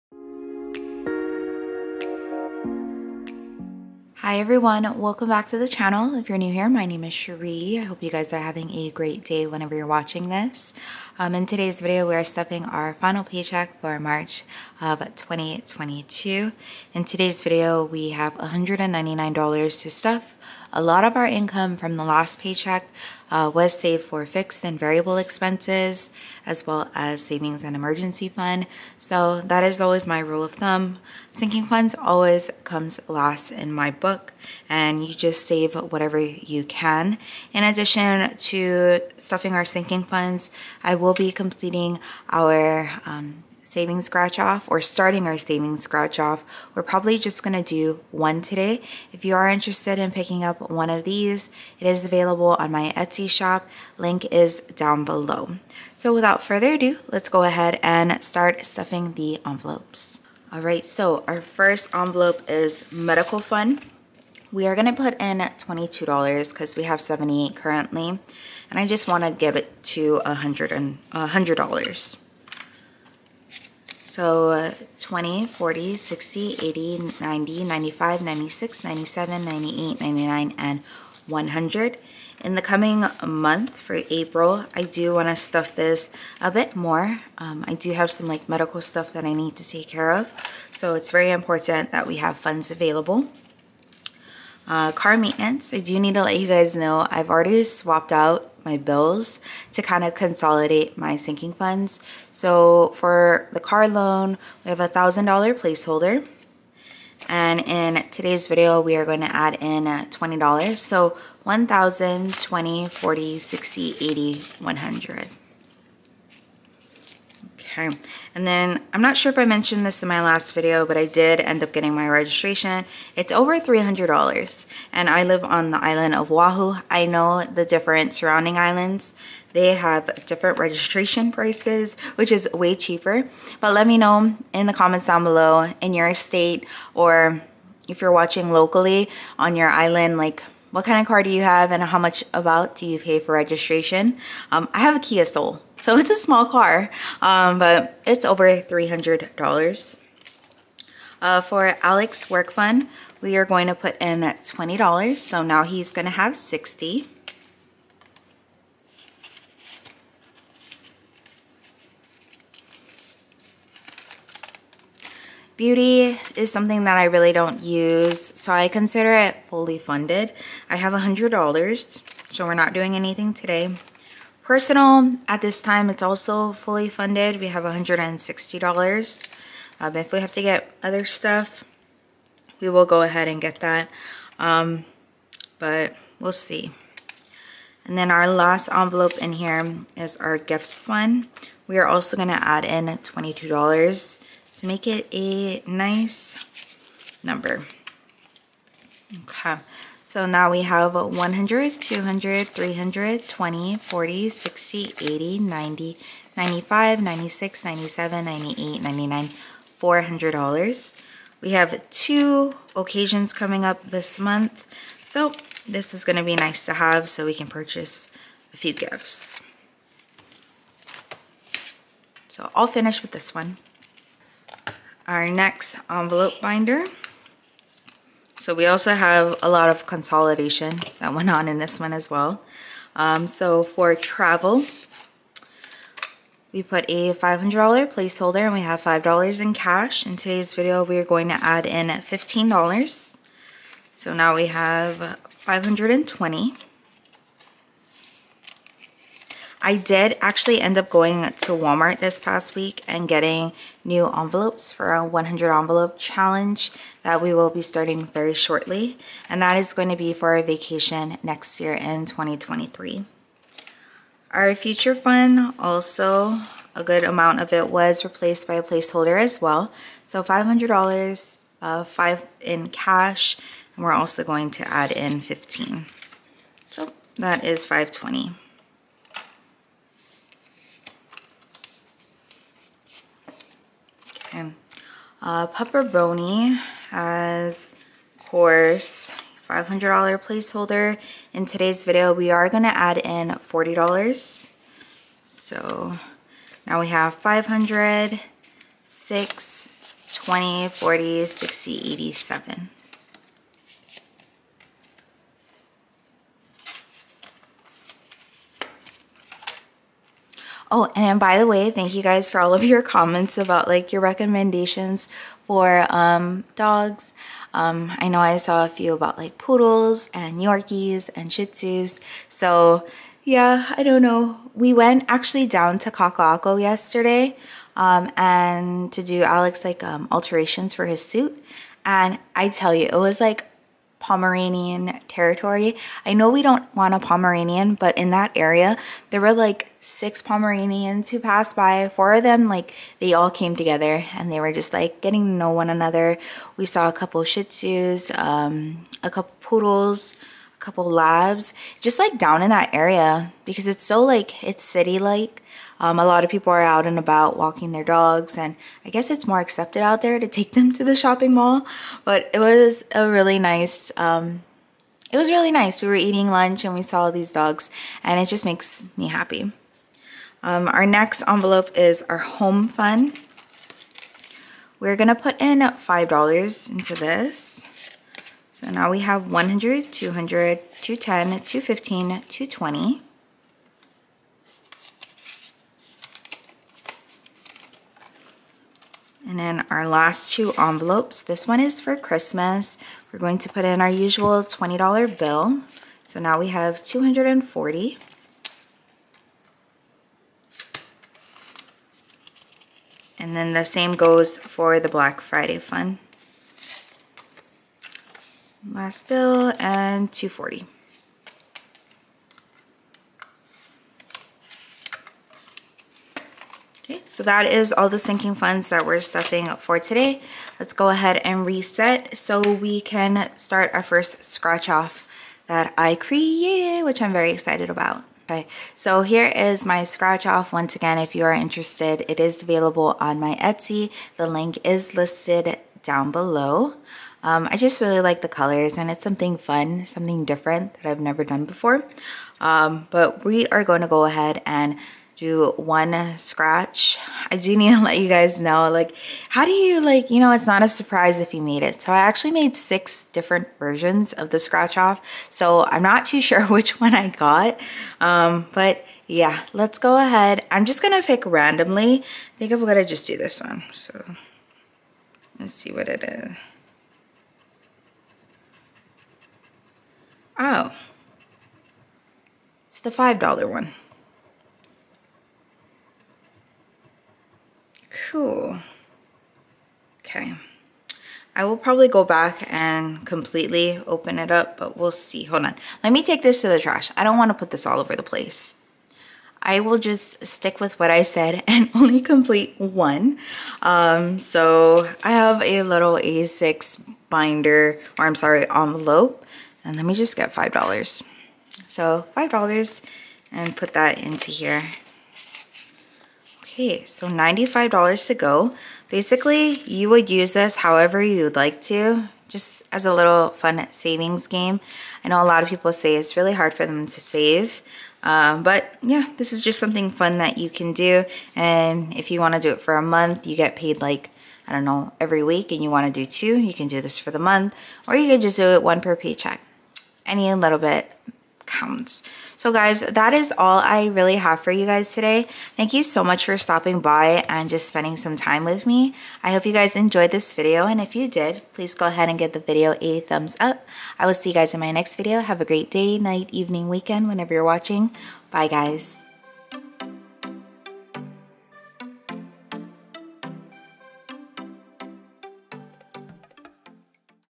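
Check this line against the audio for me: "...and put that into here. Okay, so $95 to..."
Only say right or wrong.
right.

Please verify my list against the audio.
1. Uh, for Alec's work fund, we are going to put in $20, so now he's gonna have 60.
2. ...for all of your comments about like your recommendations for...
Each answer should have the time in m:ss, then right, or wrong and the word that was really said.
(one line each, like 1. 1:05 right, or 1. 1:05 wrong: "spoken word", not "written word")
1. 2:31 right
2. 5:12 right.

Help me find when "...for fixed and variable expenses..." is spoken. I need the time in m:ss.
0:24.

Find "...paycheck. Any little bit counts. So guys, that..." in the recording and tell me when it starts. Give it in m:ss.
8:48.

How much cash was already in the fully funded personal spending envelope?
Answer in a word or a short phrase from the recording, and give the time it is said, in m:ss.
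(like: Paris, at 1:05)
$160, at 2:57.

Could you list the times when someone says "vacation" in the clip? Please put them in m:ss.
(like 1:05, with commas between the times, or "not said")
4:20.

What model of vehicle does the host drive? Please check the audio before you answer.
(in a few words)
Kia Soul.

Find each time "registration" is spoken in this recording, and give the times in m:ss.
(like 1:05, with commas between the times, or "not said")
2:02, 2:10, 2:23.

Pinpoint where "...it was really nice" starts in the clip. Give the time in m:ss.
6:05.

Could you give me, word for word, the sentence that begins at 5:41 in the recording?
Four of them, like, they all came together and they were just like getting to know one another.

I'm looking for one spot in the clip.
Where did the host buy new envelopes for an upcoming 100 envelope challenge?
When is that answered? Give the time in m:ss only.
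4:11.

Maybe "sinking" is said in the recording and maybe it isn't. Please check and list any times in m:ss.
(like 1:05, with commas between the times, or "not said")
0:31, 0:39, 1:41, 6:57.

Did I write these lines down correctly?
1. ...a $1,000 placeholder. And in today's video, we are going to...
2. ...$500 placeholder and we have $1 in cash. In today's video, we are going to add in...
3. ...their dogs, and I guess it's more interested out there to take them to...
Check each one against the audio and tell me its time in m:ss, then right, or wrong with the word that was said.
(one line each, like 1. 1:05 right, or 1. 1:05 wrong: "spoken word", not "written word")
1. 1:44 right
2. 3:57 wrong: "5", not "1"
3. 5:57 wrong: "accepted", not "interested".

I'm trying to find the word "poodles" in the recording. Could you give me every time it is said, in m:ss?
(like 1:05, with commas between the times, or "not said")
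5:19, 5:49.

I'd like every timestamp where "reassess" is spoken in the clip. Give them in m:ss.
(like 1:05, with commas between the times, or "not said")
not said.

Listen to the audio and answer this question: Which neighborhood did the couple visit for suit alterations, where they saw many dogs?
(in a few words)
Kaka'ako.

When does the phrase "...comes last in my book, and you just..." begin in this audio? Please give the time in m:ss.
0:32.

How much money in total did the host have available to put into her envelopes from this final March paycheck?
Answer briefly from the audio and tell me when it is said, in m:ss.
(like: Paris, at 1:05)
$199, at 0:18.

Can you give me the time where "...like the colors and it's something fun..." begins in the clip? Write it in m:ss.
7:17.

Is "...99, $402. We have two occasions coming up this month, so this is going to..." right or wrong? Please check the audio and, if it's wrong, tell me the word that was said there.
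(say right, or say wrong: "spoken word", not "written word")
wrong: "400", not "402".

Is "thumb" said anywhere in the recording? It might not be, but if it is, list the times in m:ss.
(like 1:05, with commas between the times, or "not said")
0:30, 9:03.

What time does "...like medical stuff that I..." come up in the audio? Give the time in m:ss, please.
1:28.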